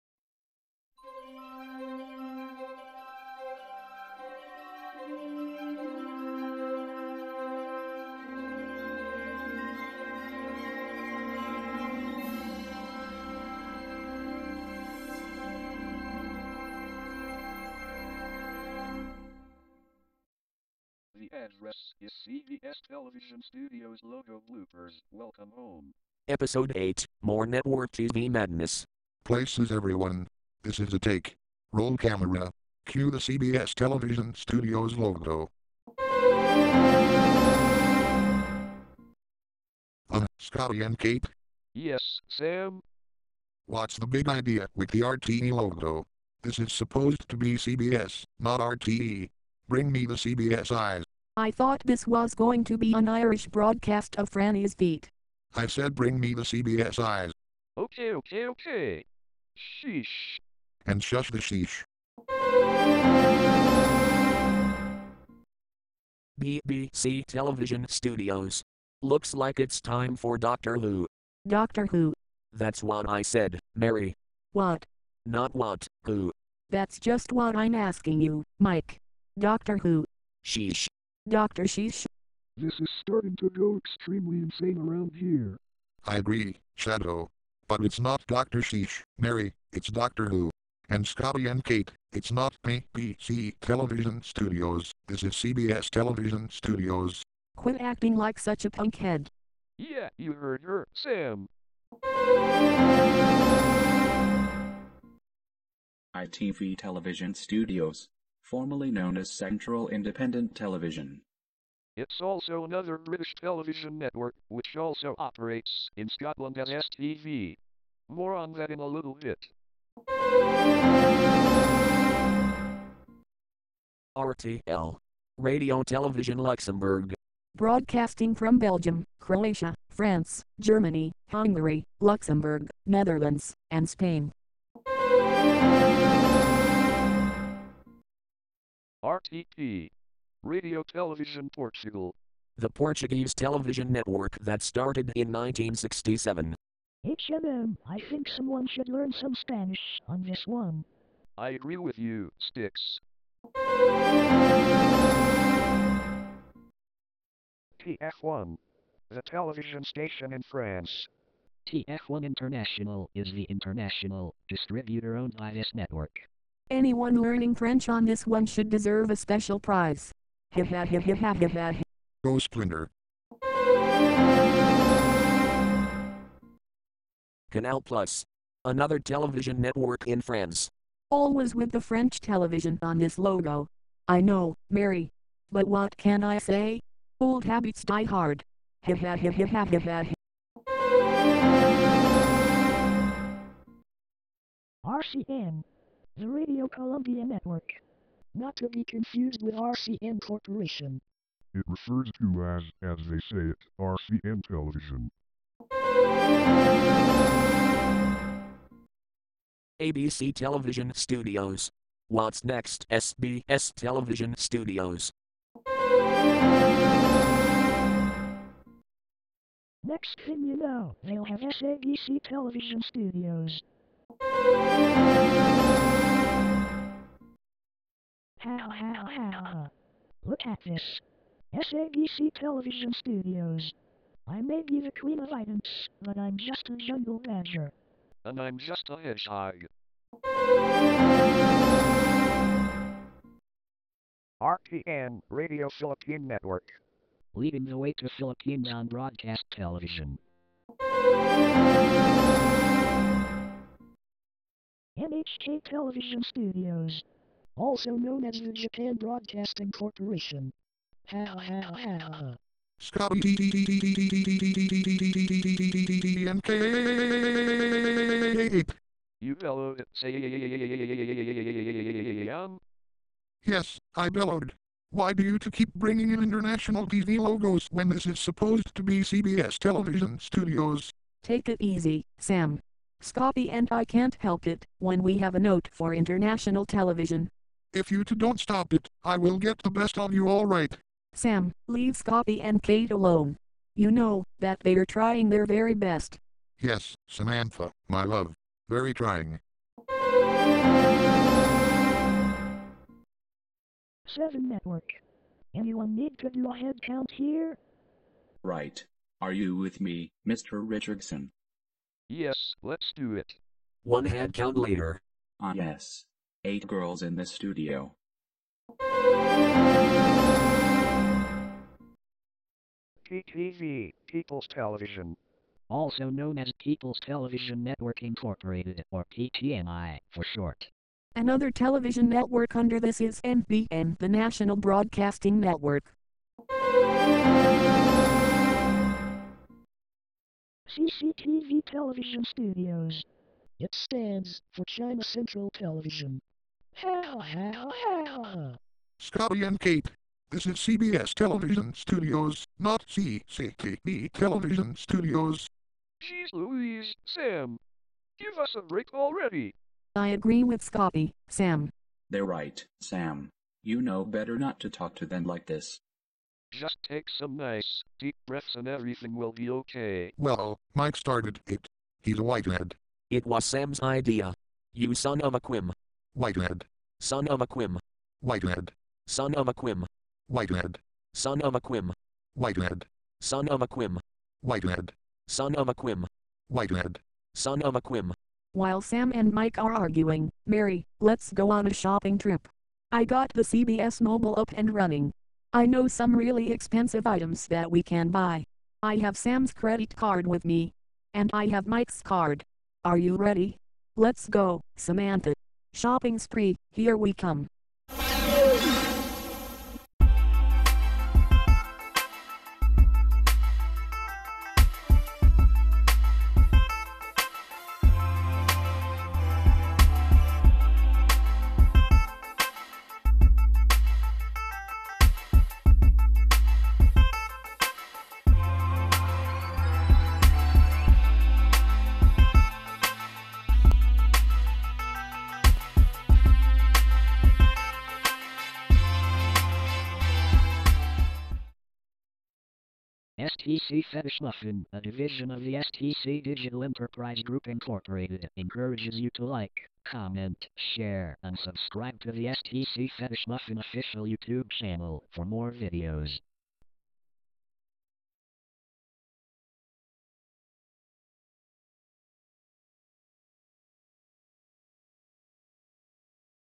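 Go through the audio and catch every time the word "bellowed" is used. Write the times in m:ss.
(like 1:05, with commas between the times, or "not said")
4:29, 4:34.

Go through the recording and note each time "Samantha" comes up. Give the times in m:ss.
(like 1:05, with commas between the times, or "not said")
4:57, 6:44.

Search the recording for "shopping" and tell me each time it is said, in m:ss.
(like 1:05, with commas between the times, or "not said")
6:31, 6:45.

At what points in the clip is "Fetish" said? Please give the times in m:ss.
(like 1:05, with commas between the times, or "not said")
7:23, 7:32.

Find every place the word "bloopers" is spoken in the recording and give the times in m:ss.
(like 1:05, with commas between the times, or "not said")
0:24.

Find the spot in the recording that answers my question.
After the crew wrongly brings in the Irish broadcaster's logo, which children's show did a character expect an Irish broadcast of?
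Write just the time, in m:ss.
0:54.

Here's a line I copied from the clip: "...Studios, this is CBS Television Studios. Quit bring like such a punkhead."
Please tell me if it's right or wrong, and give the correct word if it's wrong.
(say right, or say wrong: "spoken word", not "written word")
wrong: "acting", not "bring".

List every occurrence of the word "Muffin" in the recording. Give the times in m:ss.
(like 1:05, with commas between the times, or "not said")
7:24, 7:33.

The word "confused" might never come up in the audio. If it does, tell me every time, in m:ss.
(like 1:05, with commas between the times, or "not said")
3:18.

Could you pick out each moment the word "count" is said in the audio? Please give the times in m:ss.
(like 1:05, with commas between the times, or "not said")
5:06, 5:14.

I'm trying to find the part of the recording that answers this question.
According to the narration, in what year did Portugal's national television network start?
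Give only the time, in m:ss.
2:25.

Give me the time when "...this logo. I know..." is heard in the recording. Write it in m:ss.
3:02.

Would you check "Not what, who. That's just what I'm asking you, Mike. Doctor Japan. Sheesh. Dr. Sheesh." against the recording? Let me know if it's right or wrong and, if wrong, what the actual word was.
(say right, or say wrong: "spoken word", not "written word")
wrong: "Who", not "Japan".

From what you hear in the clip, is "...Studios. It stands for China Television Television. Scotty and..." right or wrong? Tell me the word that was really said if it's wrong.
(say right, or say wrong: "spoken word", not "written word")
wrong: "Central", not "Television".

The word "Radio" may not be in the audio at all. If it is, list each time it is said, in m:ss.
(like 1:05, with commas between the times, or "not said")
2:05, 2:20, 3:16, 4:05.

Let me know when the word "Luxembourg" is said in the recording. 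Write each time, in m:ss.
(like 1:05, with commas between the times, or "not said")
2:06, 2:12.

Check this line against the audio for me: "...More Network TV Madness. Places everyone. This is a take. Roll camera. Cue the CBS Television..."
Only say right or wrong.
right.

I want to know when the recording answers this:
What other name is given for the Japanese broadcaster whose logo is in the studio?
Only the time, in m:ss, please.
4:18.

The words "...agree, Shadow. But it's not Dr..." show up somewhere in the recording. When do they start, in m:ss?
1:26.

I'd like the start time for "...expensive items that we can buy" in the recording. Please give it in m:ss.
6:36.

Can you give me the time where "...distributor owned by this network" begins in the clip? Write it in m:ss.
2:44.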